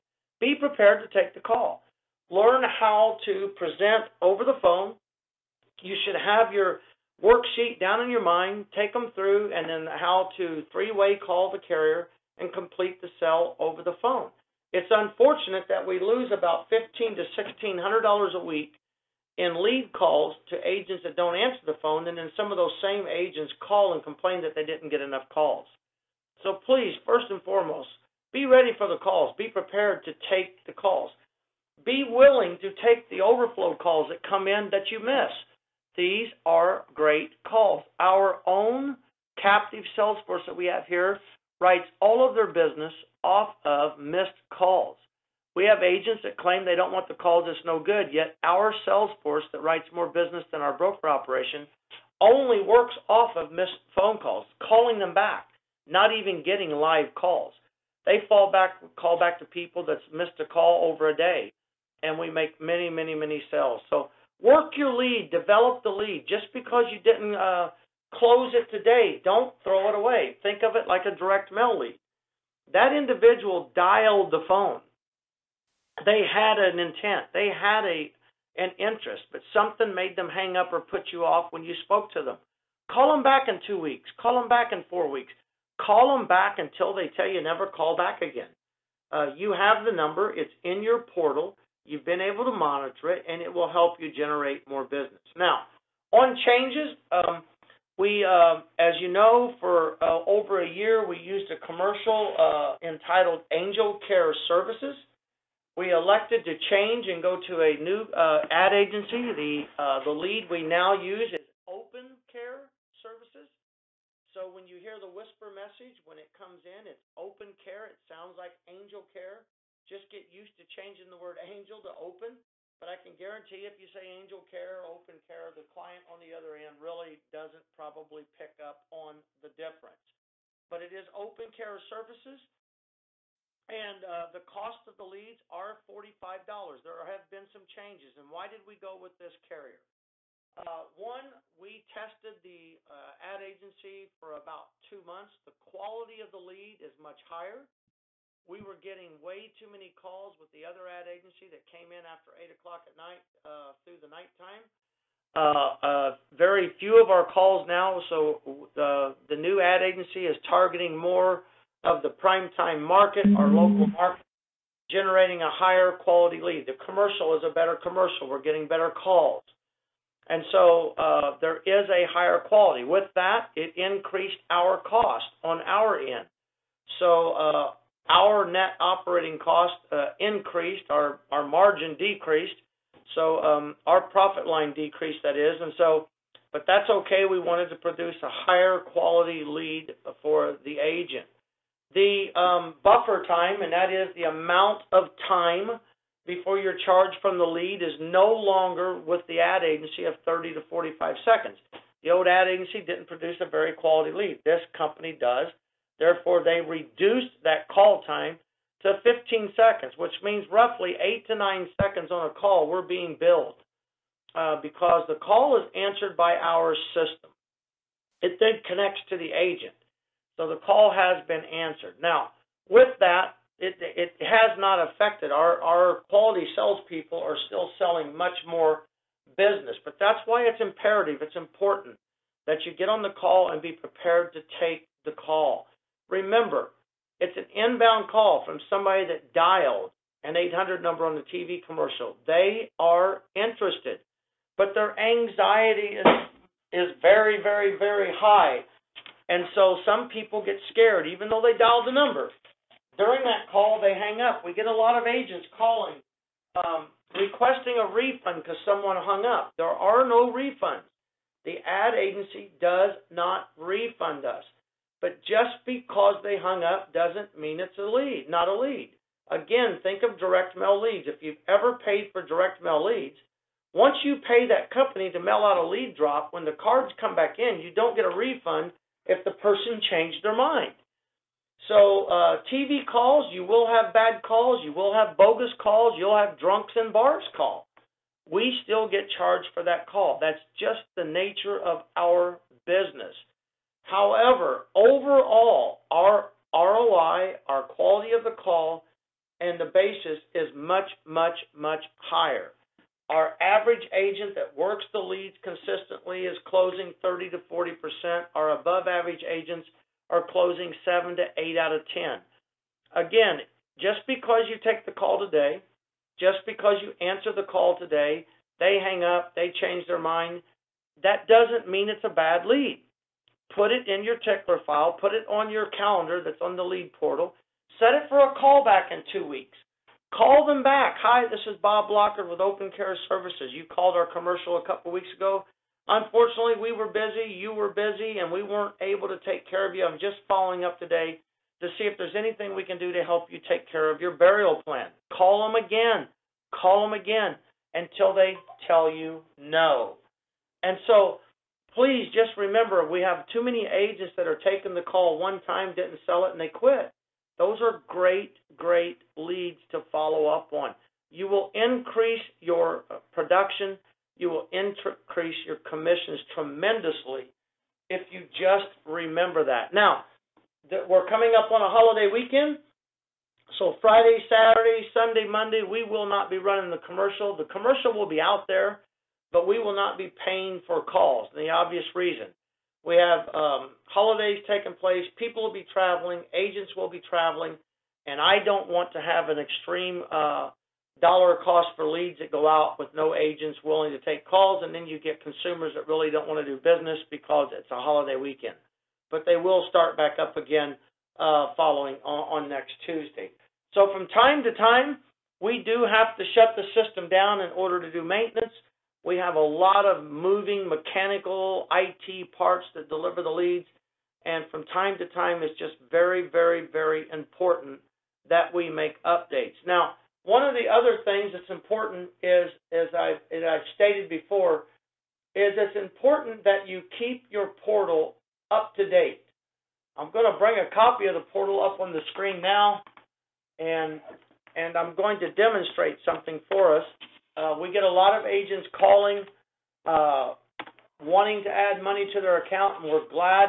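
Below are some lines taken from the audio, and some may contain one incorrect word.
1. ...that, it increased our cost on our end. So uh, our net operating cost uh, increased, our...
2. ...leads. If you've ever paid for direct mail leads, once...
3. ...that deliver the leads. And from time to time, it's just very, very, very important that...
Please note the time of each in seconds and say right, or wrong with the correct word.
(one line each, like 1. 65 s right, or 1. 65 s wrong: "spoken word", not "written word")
1. 173 s right
2. 270 s right
3. 412 s right.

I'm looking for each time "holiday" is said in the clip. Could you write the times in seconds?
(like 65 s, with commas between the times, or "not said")
371 s, 383 s, 397 s.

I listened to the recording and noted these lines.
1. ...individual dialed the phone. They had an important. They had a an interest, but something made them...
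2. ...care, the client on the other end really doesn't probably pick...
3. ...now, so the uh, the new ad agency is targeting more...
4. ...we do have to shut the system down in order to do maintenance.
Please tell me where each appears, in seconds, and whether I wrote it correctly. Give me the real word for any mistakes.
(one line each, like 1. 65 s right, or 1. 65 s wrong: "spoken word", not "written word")
1. 72 s wrong: "intent", not "important"
2. 125 s right
3. 157 s right
4. 405 s right.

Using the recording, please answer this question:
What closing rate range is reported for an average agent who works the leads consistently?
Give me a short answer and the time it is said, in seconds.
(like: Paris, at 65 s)
30%-40%, at 307 s.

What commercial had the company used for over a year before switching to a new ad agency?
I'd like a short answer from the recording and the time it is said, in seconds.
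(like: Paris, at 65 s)
Angel Care Services, at 103 s.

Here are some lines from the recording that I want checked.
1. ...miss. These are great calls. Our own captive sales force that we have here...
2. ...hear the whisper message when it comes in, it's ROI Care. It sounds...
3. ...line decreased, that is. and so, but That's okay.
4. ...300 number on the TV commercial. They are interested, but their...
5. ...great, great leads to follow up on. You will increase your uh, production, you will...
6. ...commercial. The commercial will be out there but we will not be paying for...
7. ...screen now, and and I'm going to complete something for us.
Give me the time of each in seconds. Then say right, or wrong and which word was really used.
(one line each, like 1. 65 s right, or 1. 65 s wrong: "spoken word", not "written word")
1. 34 s right
2. 114 s wrong: "Open", not "ROI"
3. 184 s right
4. 240 s wrong: "800", not "300"
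5. 357 s right
6. 376 s right
7. 432 s wrong: "demonstrate", not "complete".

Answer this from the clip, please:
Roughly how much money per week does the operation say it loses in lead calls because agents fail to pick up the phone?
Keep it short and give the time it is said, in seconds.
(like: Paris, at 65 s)
1500-1600 dollars, at 16 s.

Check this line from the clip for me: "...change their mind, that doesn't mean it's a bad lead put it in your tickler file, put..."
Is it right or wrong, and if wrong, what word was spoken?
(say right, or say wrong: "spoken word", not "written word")
right.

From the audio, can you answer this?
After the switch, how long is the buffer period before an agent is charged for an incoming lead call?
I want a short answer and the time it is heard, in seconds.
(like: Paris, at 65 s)
15 seconds, at 209 s.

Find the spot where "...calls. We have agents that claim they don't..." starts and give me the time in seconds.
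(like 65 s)
44 s.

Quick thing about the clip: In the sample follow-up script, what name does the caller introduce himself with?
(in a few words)
Bob Lockard.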